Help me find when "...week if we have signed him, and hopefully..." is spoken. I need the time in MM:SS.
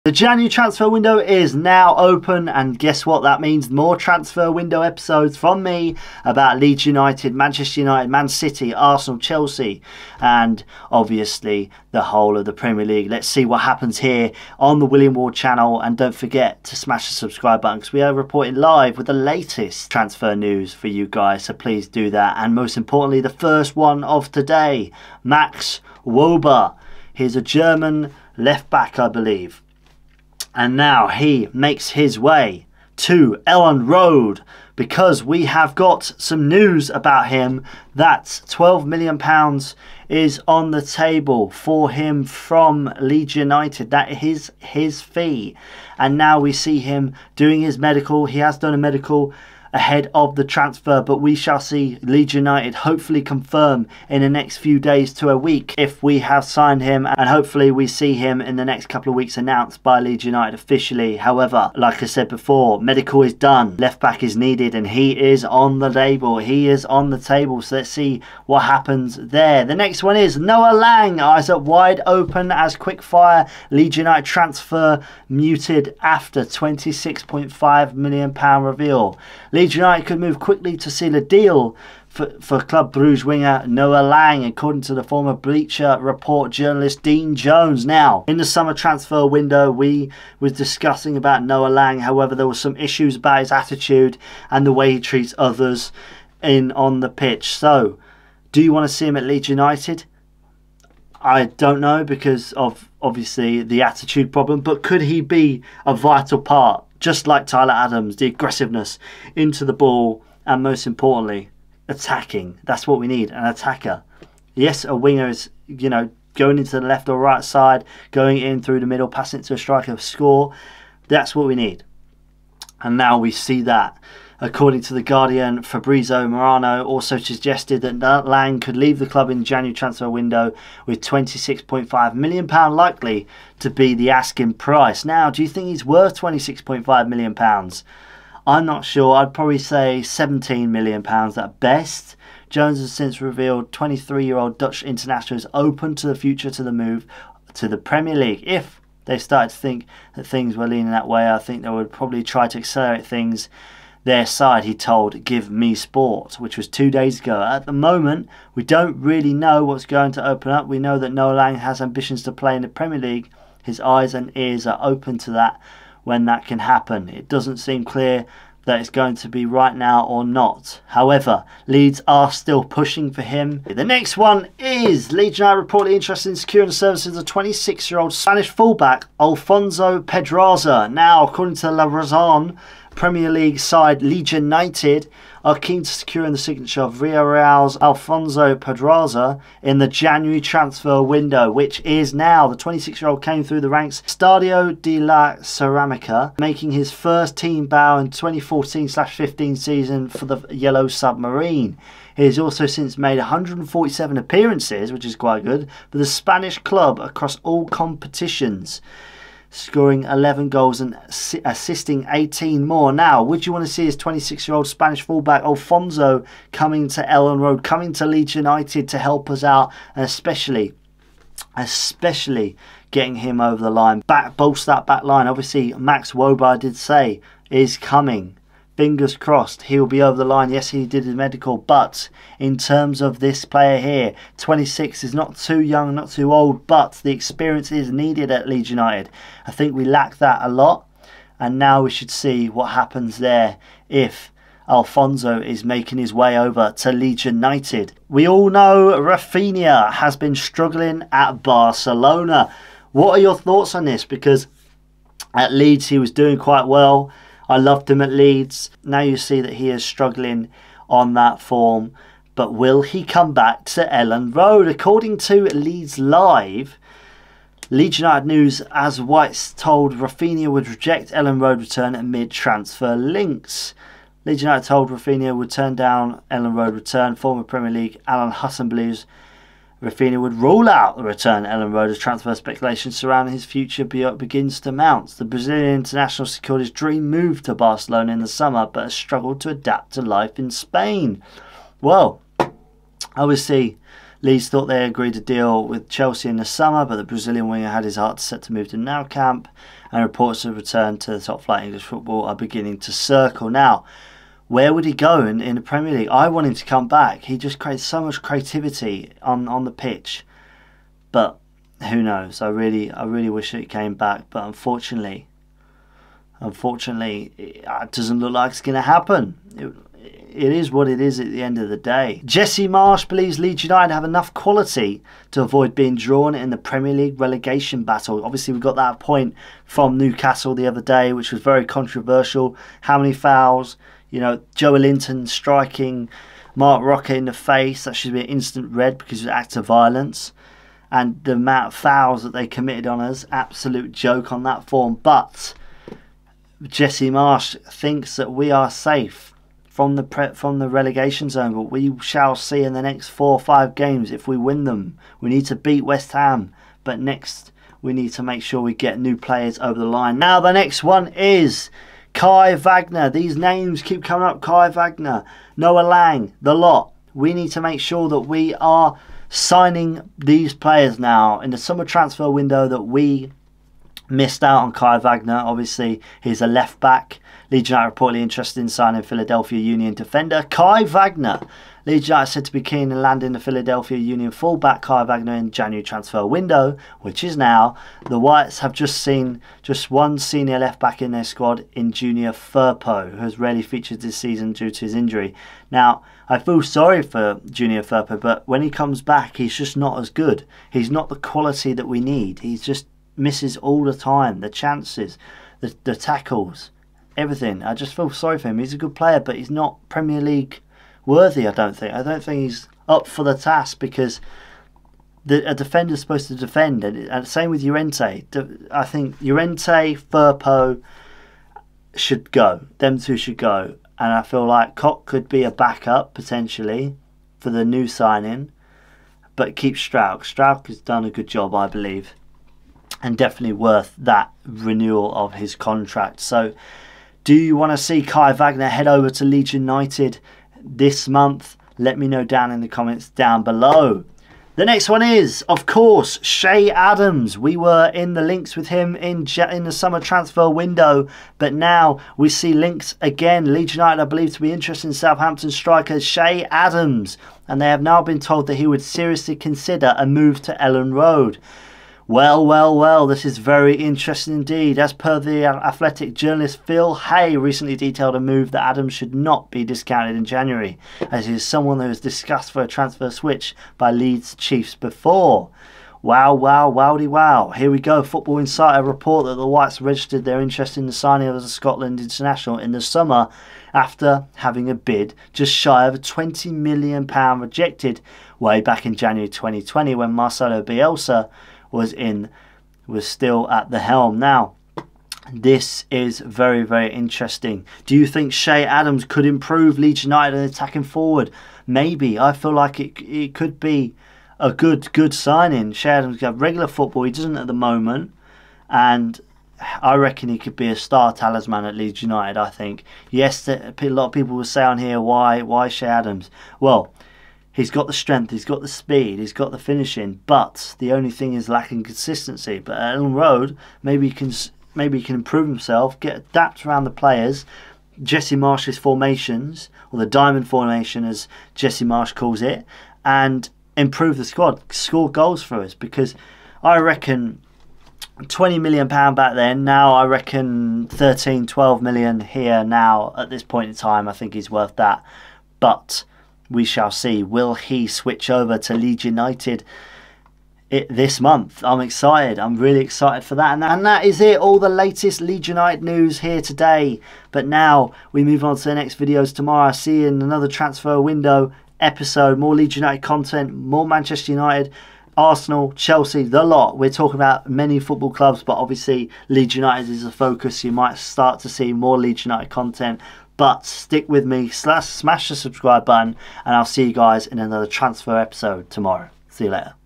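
00:55.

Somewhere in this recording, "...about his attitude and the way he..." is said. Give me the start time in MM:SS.
01:33.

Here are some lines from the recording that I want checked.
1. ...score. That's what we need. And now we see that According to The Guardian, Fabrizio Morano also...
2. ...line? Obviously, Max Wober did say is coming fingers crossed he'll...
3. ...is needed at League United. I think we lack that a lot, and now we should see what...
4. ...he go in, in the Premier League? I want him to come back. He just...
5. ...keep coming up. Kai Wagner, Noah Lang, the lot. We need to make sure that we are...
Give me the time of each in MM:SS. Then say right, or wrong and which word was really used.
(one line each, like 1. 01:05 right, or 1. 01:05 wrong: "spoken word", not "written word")
1. 01:59 right
2. 03:45 right
3. 03:57 wrong: "Leeds", not "League"
4. 05:04 right
5. 06:03 right.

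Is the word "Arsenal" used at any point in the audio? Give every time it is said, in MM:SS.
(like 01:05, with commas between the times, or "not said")
00:08, 09:25.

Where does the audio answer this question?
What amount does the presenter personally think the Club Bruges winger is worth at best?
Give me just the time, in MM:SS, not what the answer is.
02:20.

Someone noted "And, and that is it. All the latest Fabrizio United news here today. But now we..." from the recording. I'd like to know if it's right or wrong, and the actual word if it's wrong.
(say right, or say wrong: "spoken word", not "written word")
wrong: "Leeds", not "Fabrizio".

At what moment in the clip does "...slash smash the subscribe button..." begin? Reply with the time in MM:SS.
09:34.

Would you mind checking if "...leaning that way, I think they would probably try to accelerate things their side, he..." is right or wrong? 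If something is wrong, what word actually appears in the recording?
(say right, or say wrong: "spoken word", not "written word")
right.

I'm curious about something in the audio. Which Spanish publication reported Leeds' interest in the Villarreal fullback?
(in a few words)
La Razón.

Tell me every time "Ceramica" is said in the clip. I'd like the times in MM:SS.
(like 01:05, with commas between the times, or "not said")
03:15.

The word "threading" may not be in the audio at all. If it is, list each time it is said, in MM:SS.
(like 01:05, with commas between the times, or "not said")
not said.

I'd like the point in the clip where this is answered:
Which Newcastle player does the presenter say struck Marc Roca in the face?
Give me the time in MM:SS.
05:34.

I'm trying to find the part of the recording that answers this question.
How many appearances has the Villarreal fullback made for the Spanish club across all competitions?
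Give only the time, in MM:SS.
03:23.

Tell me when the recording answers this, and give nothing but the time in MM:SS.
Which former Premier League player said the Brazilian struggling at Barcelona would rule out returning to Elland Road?
04:38.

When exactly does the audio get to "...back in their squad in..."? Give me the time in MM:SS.
06:30.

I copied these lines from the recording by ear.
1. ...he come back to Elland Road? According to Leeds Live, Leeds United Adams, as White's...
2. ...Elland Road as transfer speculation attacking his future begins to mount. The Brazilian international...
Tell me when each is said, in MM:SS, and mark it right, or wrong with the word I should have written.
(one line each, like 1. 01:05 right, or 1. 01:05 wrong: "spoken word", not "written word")
1. 04:22 wrong: "News", not "Adams"
2. 04:41 wrong: "surrounding", not "attacking".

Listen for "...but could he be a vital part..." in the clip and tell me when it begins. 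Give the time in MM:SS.
01:44.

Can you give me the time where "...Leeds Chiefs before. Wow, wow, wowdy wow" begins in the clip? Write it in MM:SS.
07:53.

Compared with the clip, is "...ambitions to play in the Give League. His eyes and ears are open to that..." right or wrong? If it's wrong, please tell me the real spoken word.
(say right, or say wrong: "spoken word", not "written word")
wrong: "Premier", not "Give".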